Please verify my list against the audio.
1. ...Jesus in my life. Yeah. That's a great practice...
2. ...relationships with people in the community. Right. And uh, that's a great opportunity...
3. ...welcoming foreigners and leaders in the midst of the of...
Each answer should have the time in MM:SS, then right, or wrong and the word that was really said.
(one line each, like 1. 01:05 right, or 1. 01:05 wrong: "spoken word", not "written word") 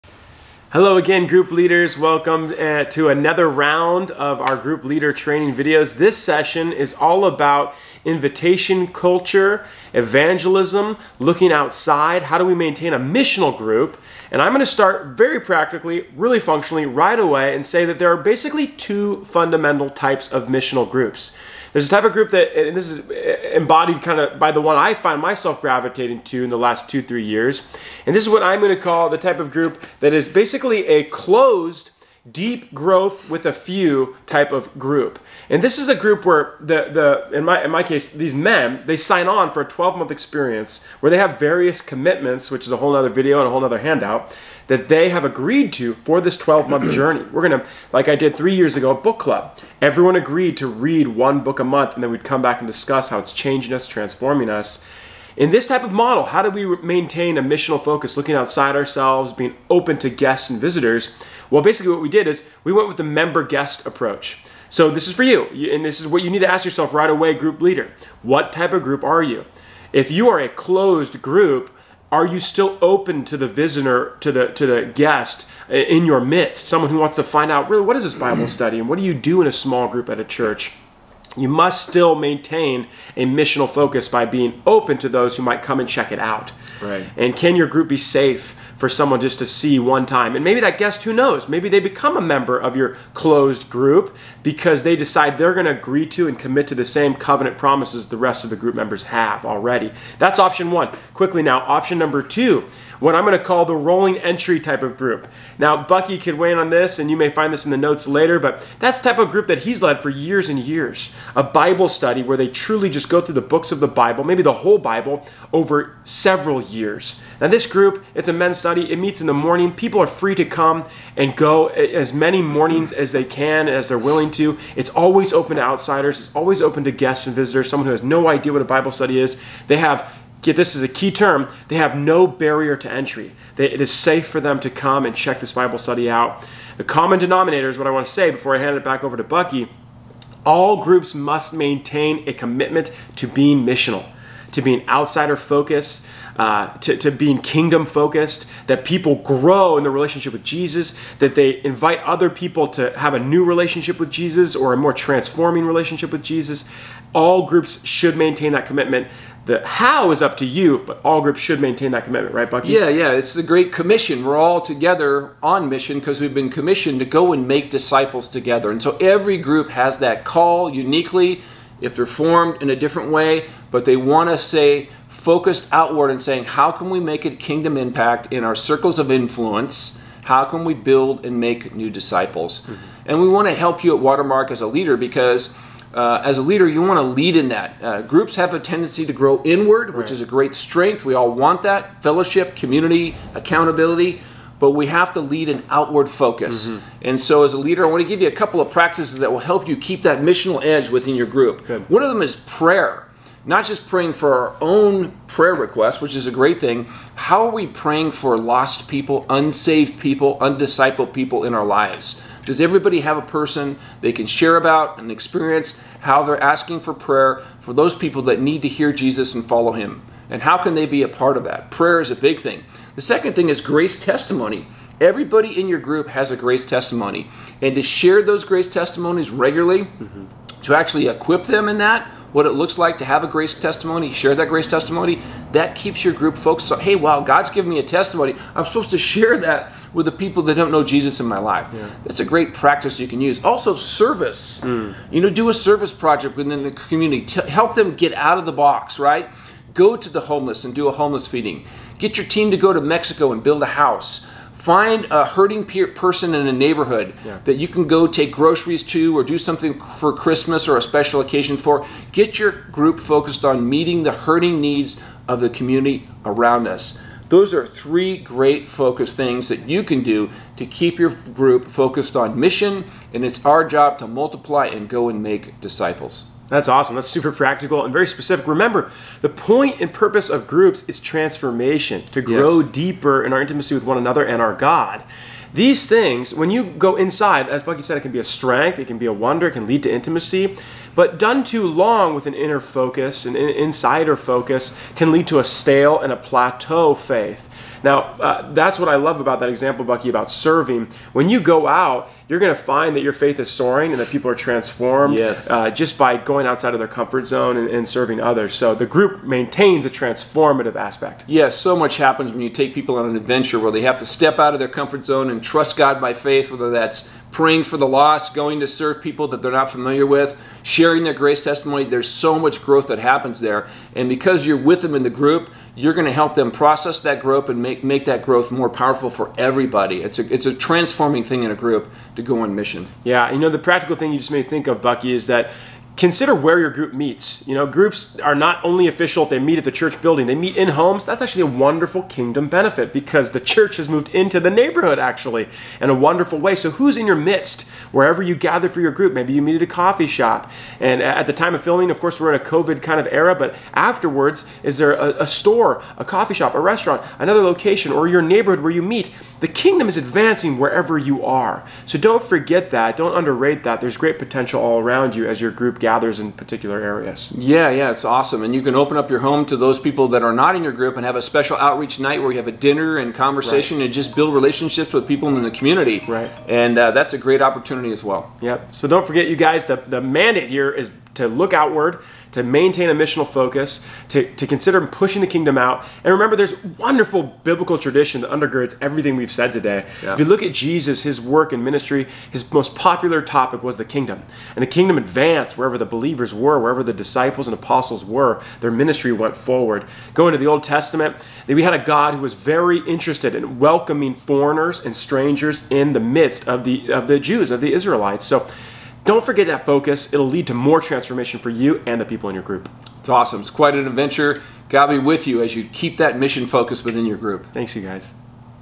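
1. 04:00 right
2. 06:14 right
3. 06:43 wrong: "strangers", not "leaders".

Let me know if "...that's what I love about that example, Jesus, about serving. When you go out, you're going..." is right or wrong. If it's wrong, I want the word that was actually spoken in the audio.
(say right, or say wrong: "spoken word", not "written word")
wrong: "Bucky", not "Jesus".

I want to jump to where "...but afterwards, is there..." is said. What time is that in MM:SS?
05:53.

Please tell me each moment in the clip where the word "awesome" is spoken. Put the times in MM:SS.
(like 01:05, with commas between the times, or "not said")
04:36, 06:08, 06:53.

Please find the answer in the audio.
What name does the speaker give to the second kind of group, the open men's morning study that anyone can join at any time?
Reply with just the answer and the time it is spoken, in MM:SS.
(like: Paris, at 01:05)
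Rolling entry, at 01:43.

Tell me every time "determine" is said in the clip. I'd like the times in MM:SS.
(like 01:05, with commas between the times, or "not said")
not said.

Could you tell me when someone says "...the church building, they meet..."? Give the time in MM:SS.
05:39.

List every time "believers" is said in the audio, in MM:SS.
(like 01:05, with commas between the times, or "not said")
06:35.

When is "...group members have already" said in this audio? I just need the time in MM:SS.
01:38.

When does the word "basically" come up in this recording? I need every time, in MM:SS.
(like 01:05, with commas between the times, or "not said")
00:18, 00:30, 01:01.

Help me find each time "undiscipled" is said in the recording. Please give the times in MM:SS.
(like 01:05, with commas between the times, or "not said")
03:30.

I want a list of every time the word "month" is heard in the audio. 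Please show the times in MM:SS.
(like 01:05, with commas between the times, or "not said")
00:39, 00:46, 00:51.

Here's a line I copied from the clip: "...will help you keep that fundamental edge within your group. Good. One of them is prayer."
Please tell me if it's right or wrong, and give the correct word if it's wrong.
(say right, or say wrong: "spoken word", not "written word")
wrong: "missional", not "fundamental".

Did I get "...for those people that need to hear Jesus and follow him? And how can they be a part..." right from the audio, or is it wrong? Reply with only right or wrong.
right.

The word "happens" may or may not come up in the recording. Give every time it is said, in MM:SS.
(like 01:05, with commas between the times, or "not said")
05:11, 05:22.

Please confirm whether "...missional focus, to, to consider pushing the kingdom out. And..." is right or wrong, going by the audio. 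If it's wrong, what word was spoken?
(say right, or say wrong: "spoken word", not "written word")
right.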